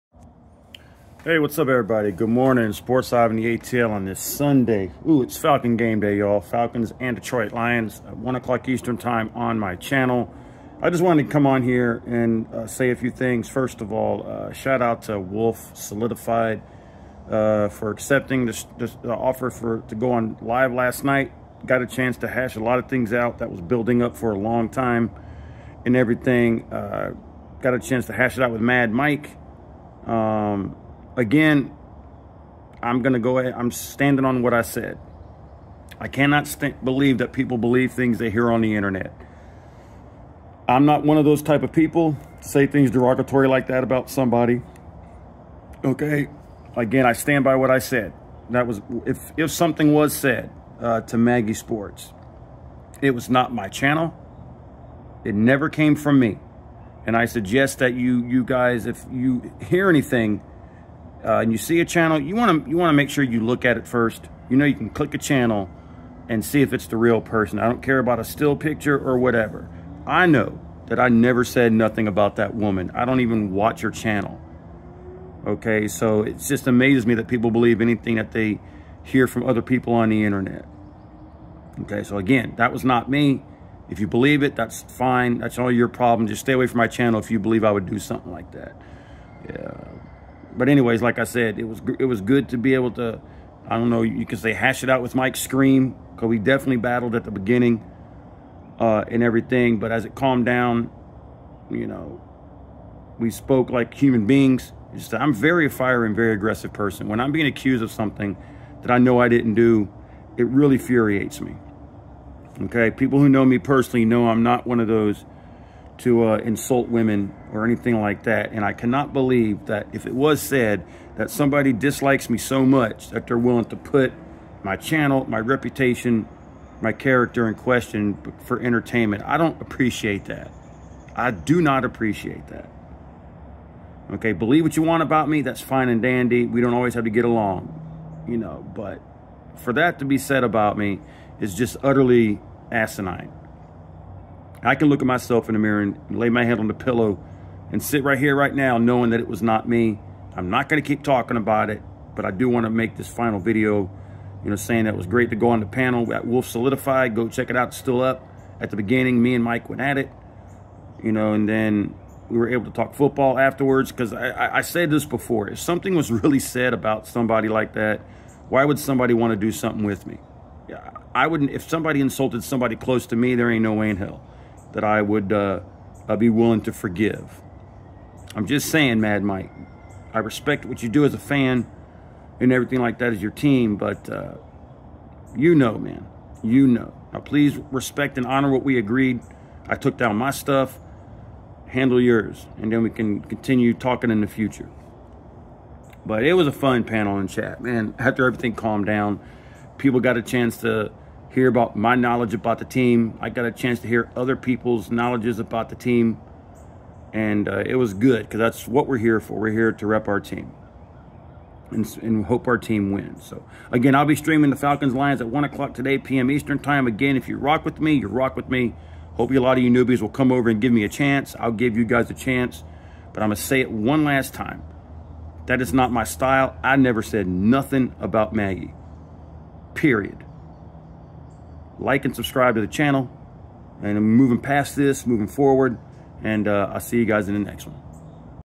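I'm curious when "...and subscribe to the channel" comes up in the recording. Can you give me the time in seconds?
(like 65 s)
232 s.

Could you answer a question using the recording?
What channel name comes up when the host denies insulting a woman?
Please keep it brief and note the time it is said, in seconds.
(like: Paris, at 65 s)
Maggie Sports, at 51 s.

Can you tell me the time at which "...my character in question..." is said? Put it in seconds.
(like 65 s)
126 s.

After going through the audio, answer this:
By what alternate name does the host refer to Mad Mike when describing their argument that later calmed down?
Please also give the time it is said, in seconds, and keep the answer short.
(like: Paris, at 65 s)
Mike Scream, at 95 s.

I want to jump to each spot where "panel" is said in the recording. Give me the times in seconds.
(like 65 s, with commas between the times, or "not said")
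155 s, 196 s.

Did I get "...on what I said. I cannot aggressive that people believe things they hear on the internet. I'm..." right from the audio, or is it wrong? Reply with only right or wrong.
wrong.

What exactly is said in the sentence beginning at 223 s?
But I'm going to say it one last time.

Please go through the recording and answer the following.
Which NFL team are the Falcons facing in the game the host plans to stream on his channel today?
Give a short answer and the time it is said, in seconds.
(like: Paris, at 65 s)
Detroit Lions, at 7 s.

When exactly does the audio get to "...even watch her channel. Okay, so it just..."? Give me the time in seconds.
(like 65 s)
73 s.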